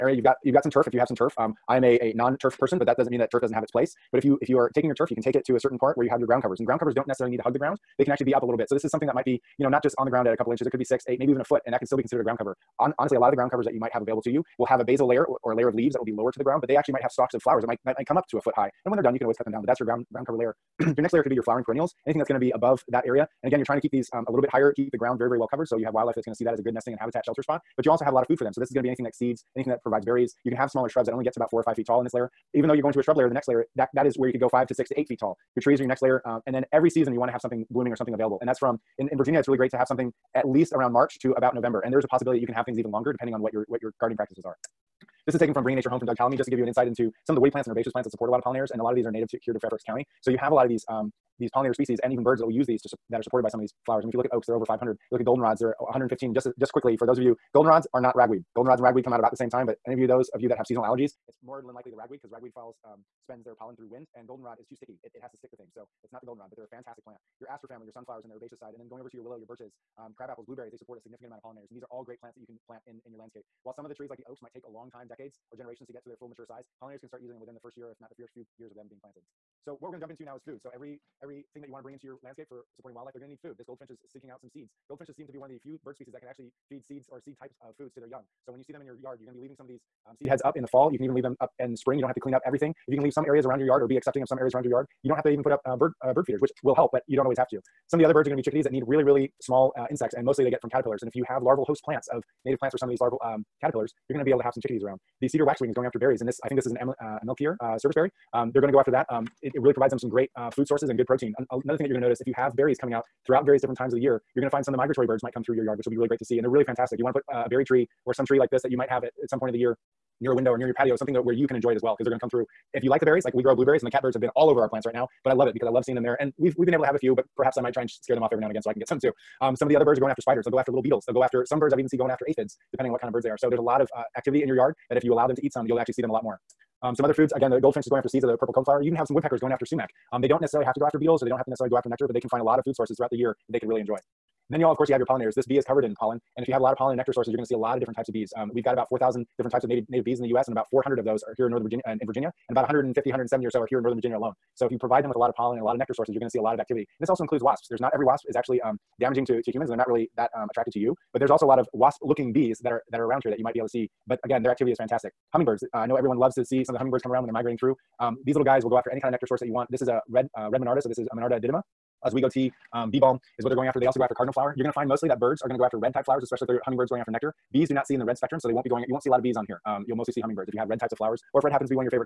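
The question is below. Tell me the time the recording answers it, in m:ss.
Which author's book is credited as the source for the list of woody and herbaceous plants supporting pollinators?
0:46.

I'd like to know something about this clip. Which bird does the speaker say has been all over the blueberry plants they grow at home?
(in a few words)
catbirds.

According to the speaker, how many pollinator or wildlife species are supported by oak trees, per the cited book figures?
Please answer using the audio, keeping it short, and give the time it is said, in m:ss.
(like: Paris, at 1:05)
over 500, at 0:54.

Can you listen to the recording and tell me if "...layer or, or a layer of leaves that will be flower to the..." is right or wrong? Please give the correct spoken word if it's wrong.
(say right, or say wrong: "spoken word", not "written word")
wrong: "lower", not "flower".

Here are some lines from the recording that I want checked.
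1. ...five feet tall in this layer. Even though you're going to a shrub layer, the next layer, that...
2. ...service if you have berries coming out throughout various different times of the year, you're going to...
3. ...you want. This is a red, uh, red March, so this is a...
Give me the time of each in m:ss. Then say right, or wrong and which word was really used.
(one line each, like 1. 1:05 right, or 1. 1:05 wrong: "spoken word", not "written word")
1. 0:31 right
2. 1:52 wrong: "notice", not "service"
3. 2:49 wrong: "Monarda", not "March".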